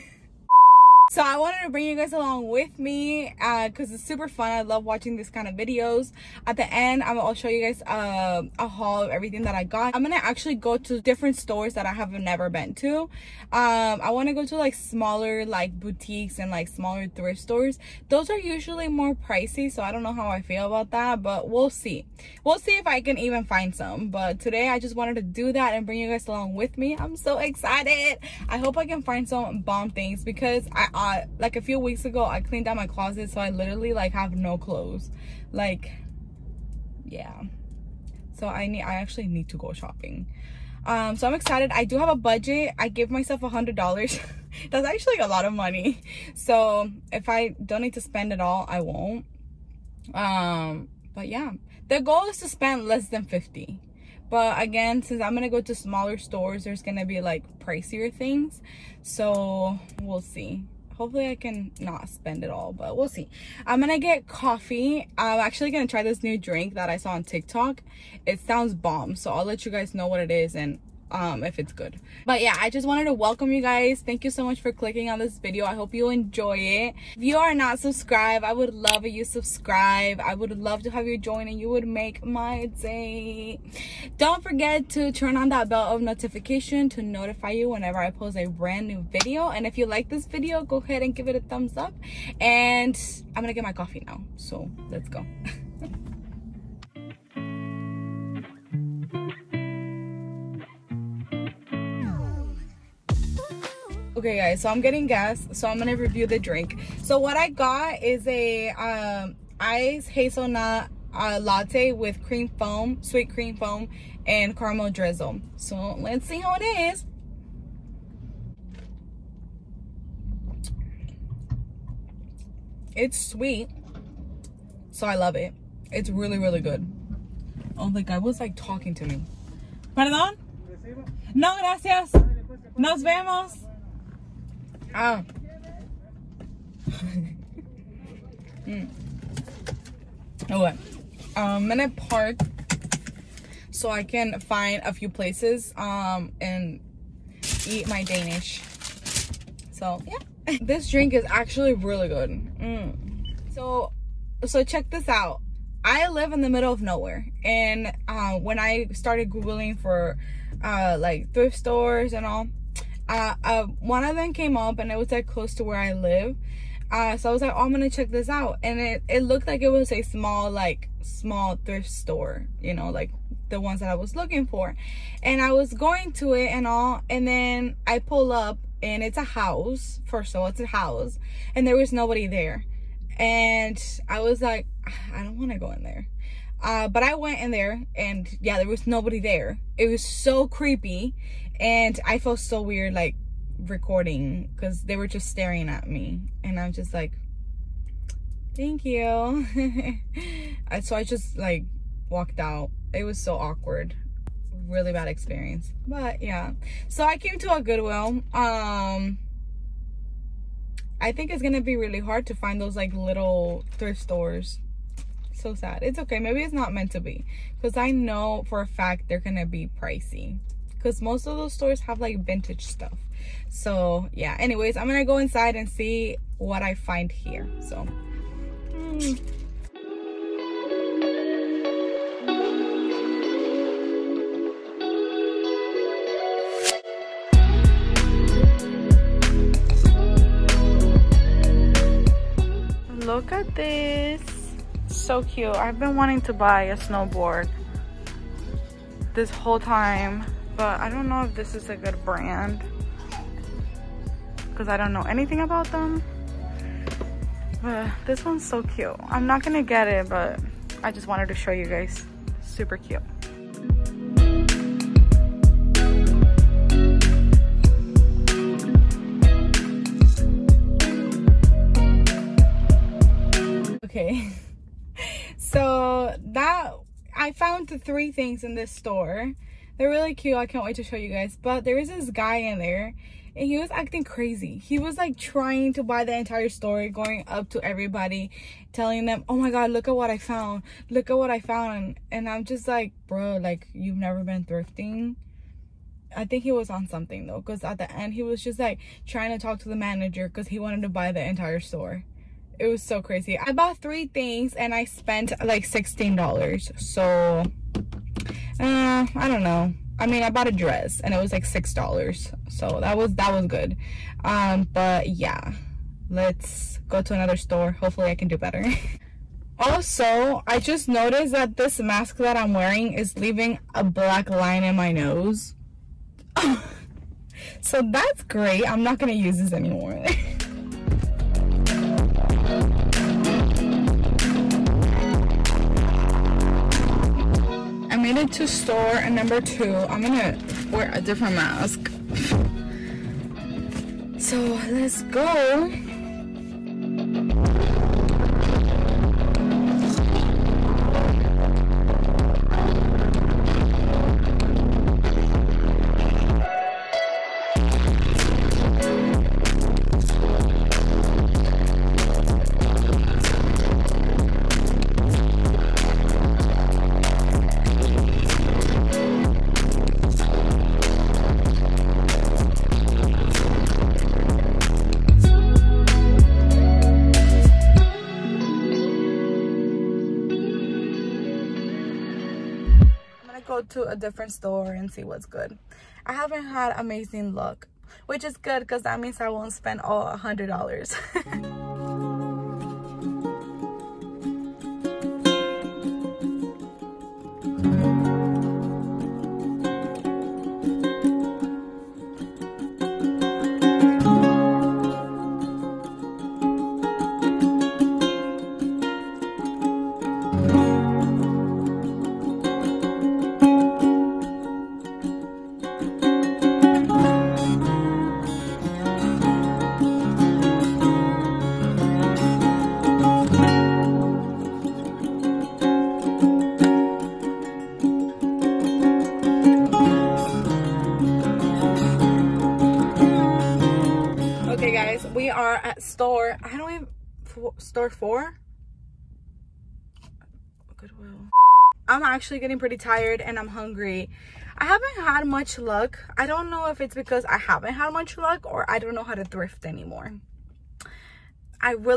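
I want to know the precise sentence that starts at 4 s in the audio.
I love watching this kind of videos.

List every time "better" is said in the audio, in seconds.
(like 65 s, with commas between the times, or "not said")
318 s.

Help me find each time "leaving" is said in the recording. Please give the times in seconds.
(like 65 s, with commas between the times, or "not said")
323 s.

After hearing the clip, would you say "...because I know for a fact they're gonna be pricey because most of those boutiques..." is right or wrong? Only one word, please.
wrong.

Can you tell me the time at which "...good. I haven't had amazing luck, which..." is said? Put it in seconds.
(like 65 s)
385 s.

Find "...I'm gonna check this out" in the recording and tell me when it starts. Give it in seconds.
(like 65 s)
167 s.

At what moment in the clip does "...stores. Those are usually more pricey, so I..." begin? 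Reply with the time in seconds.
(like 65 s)
17 s.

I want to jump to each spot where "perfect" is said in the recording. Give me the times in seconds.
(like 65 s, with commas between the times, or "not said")
not said.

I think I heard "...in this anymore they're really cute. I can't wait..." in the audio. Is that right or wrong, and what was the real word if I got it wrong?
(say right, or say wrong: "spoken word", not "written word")
wrong: "store", not "anymore".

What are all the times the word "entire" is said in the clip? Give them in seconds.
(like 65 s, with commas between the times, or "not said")
286 s, 301 s.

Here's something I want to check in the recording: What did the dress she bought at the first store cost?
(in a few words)
$6.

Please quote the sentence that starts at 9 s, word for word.
I'm going to actually go to different stores that I have never been to.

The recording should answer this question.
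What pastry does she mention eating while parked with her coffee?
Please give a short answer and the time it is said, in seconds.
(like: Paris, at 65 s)
Danish, at 148 s.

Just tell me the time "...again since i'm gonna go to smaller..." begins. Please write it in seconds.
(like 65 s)
54 s.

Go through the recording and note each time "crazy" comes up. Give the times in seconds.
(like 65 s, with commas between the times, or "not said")
284 s, 303 s.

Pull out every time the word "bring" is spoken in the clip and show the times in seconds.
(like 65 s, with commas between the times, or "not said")
1 s, 25 s.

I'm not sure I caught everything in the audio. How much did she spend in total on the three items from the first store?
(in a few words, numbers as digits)
$16.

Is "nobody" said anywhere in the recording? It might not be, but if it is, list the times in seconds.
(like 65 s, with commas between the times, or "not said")
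181 s, 188 s.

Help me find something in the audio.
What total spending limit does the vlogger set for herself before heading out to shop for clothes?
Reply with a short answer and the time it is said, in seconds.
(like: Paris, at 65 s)
$100, at 43 s.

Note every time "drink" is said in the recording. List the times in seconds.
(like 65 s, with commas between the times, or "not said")
66 s, 106 s, 150 s.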